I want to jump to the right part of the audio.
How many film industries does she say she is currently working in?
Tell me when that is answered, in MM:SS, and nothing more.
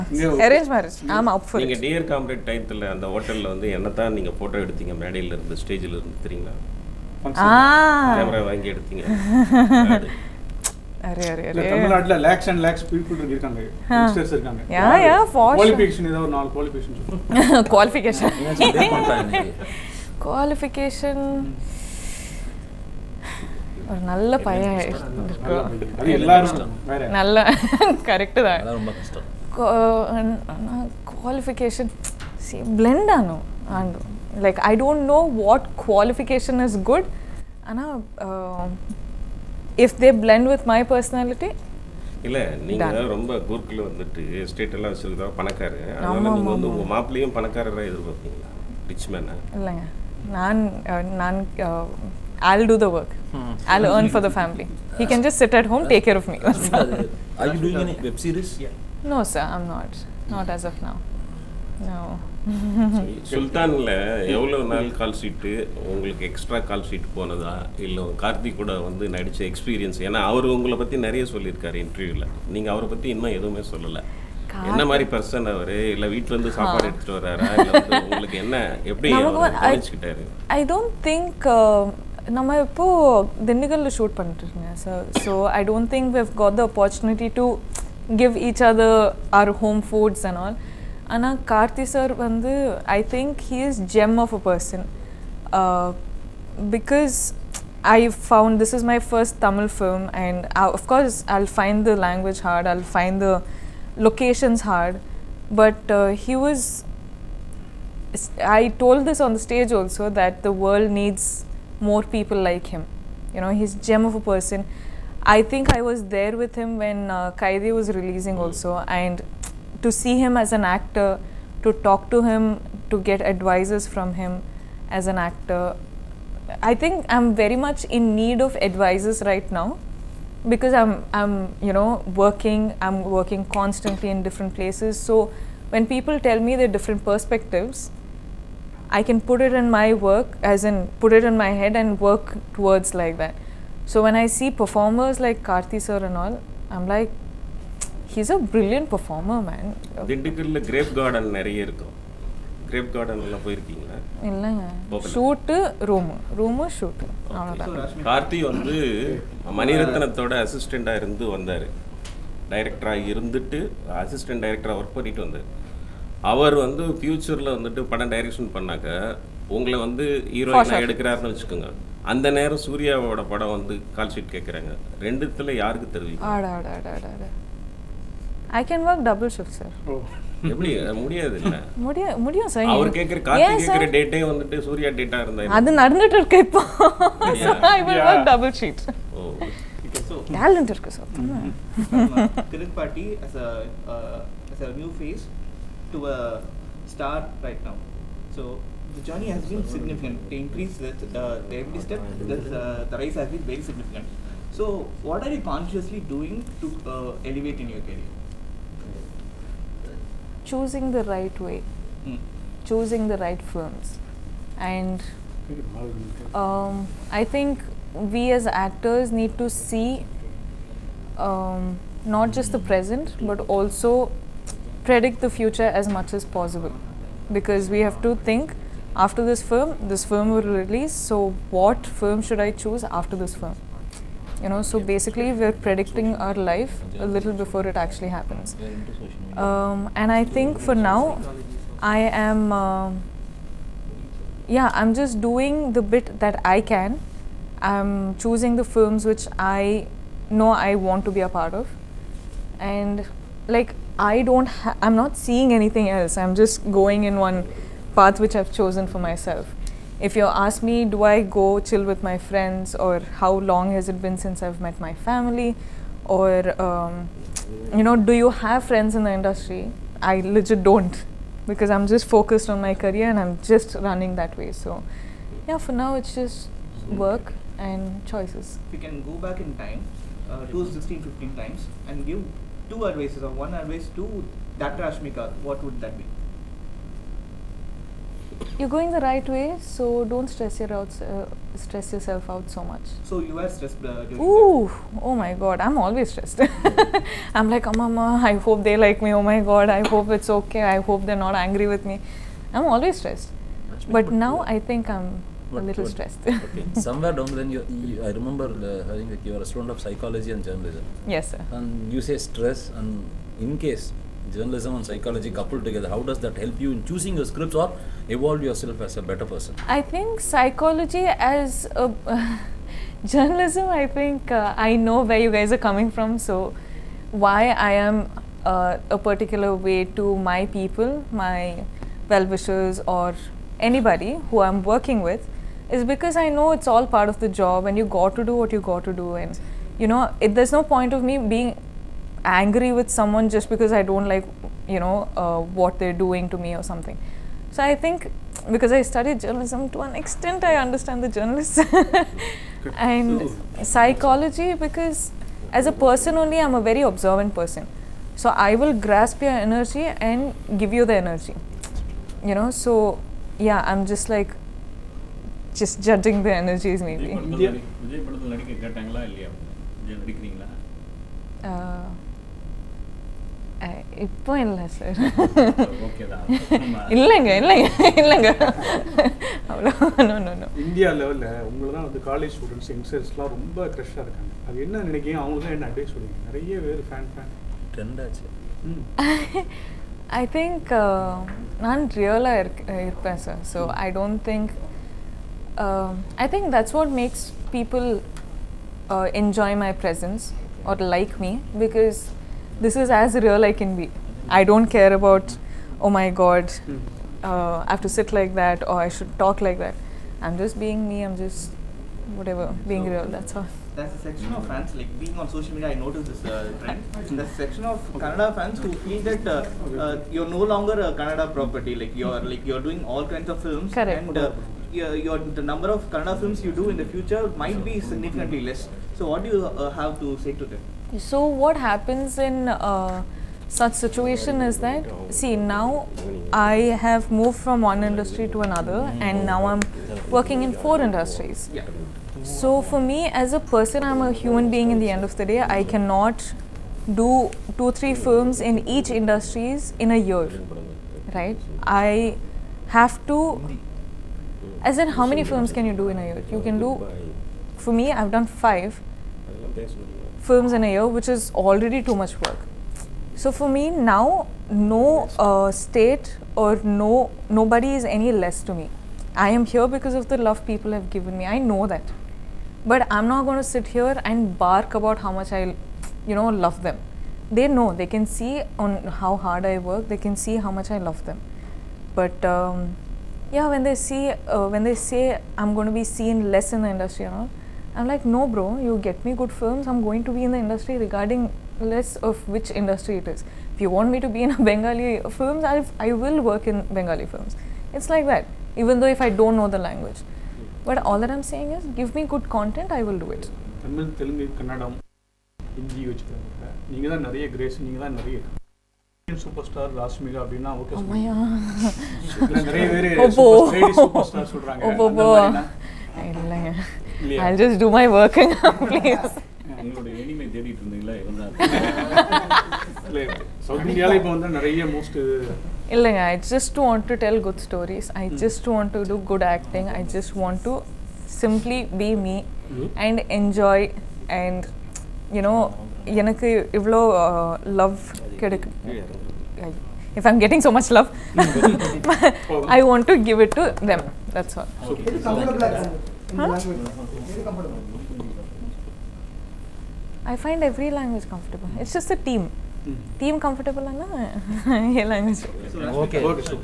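07:20.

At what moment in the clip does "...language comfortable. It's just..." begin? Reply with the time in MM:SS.
09:10.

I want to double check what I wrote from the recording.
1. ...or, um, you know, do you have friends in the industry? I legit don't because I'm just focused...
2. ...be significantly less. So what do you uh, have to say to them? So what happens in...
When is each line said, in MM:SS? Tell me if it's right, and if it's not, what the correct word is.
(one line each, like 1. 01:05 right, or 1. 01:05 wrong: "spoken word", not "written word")
1. 04:26 right
2. 07:07 right.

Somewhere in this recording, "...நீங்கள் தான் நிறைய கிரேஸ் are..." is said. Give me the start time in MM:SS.
08:26.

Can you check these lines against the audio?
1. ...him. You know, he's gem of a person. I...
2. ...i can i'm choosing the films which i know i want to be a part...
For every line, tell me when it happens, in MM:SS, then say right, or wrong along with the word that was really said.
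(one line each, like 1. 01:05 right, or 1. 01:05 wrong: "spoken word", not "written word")
1. 01:52 right
2. 04:06 right.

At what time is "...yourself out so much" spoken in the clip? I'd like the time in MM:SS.
04:51.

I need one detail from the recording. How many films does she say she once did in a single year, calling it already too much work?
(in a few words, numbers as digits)
5.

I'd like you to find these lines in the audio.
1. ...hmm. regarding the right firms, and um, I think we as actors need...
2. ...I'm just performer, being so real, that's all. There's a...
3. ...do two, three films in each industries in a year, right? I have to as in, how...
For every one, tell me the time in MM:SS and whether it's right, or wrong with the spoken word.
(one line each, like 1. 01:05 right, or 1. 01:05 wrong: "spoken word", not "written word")
1. 03:32 wrong: "choosing", not "regarding"
2. 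06:51 wrong: "whatever", not "performer"
3. 07:26 right.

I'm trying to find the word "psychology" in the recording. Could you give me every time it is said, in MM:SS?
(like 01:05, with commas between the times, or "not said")
05:09, 05:14, 05:20, 05:53.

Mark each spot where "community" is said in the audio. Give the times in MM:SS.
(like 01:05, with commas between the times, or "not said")
not said.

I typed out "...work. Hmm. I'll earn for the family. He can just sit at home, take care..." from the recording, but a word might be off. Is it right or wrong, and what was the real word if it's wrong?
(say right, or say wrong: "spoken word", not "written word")
right.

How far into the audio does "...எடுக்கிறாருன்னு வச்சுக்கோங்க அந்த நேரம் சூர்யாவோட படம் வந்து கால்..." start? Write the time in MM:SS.
02:50.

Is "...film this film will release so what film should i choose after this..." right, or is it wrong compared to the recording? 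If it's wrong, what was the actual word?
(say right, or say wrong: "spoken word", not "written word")
right.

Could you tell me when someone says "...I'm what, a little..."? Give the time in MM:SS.
05:04.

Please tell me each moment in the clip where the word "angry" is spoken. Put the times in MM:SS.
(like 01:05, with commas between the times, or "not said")
05:01, 05:42.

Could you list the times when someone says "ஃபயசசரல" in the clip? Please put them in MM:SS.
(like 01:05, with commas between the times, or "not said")
02:46.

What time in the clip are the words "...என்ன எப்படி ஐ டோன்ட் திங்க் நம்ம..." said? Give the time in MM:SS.
01:18.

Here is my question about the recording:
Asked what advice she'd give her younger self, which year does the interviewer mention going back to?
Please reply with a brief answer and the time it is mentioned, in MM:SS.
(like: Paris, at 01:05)
2016, at 04:40.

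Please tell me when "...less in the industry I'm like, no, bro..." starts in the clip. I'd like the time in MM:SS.
08:06.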